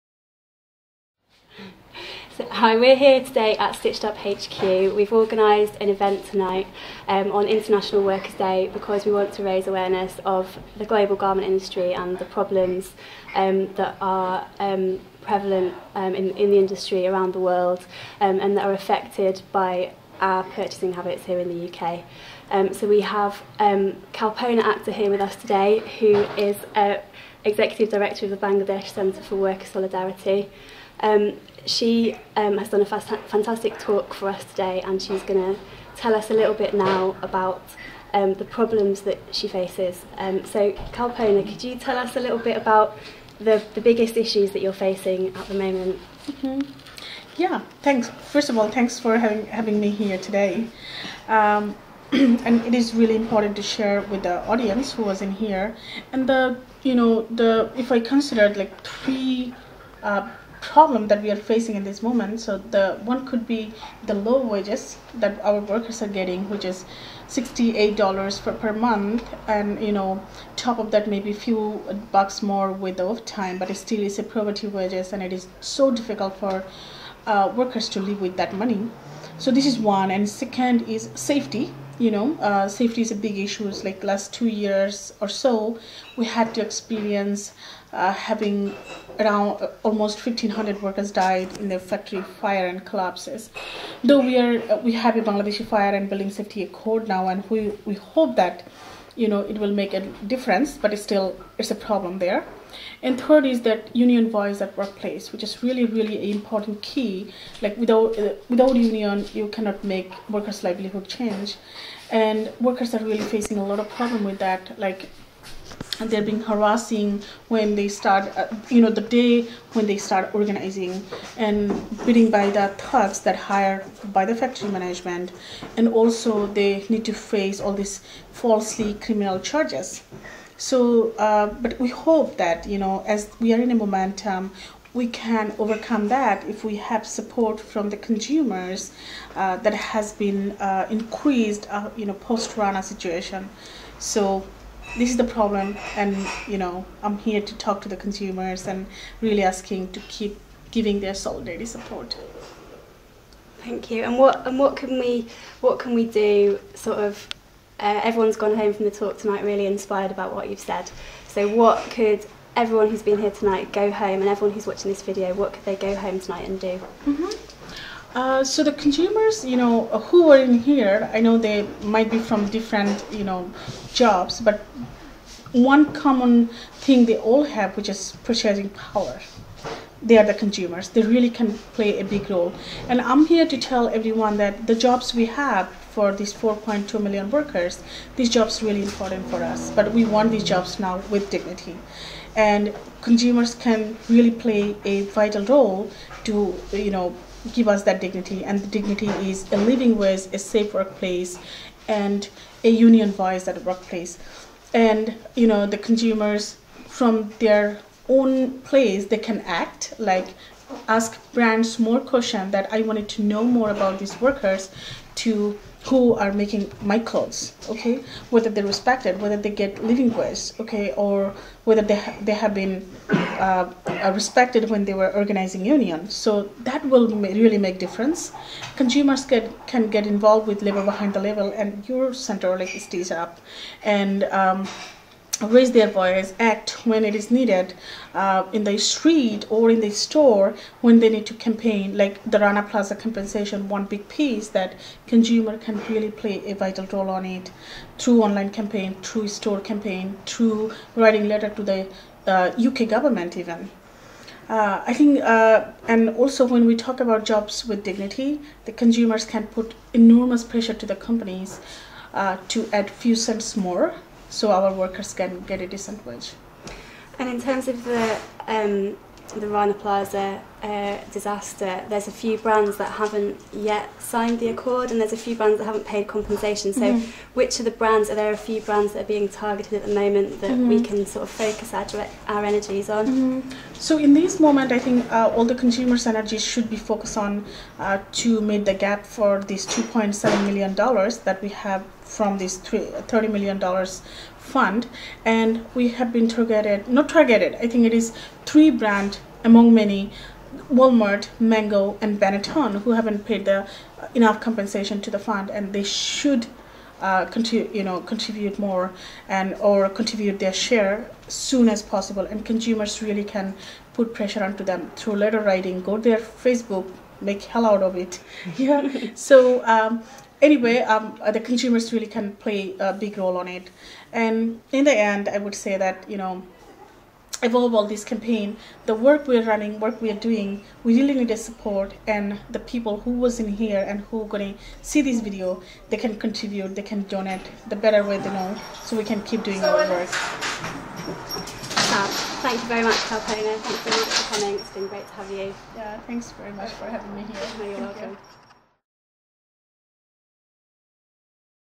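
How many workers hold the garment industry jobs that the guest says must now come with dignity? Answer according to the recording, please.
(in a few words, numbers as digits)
4.2 million.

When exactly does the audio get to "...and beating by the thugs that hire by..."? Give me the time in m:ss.
2:01.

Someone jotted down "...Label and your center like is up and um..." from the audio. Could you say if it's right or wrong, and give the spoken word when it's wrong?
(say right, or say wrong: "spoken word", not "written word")
right.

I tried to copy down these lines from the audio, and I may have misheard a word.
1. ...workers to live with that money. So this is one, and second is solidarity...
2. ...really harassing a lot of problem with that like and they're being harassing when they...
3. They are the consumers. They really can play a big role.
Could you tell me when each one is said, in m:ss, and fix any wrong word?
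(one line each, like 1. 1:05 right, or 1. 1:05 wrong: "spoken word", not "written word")
1. 1:17 wrong: "safety", not "solidarity"
2. 1:53 wrong: "facing", not "harassing"
3. 3:00 right.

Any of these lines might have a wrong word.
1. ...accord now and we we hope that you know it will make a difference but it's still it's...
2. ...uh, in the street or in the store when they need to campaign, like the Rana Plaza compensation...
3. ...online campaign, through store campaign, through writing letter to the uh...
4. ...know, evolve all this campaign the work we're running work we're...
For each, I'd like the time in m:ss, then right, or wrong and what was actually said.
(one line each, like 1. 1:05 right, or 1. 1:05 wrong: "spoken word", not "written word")
1. 1:36 right
2. 3:58 right
3. 4:08 right
4. 5:26 right.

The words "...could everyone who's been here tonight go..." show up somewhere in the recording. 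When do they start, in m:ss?
2:41.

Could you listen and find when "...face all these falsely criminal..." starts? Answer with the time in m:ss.
2:07.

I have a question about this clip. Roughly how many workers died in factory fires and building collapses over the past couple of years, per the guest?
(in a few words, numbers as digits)
1500.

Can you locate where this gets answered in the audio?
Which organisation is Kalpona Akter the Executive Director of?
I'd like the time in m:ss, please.
0:28.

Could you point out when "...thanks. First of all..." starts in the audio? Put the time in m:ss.
0:47.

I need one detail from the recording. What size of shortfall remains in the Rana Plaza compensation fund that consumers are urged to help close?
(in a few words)
$2.7 million.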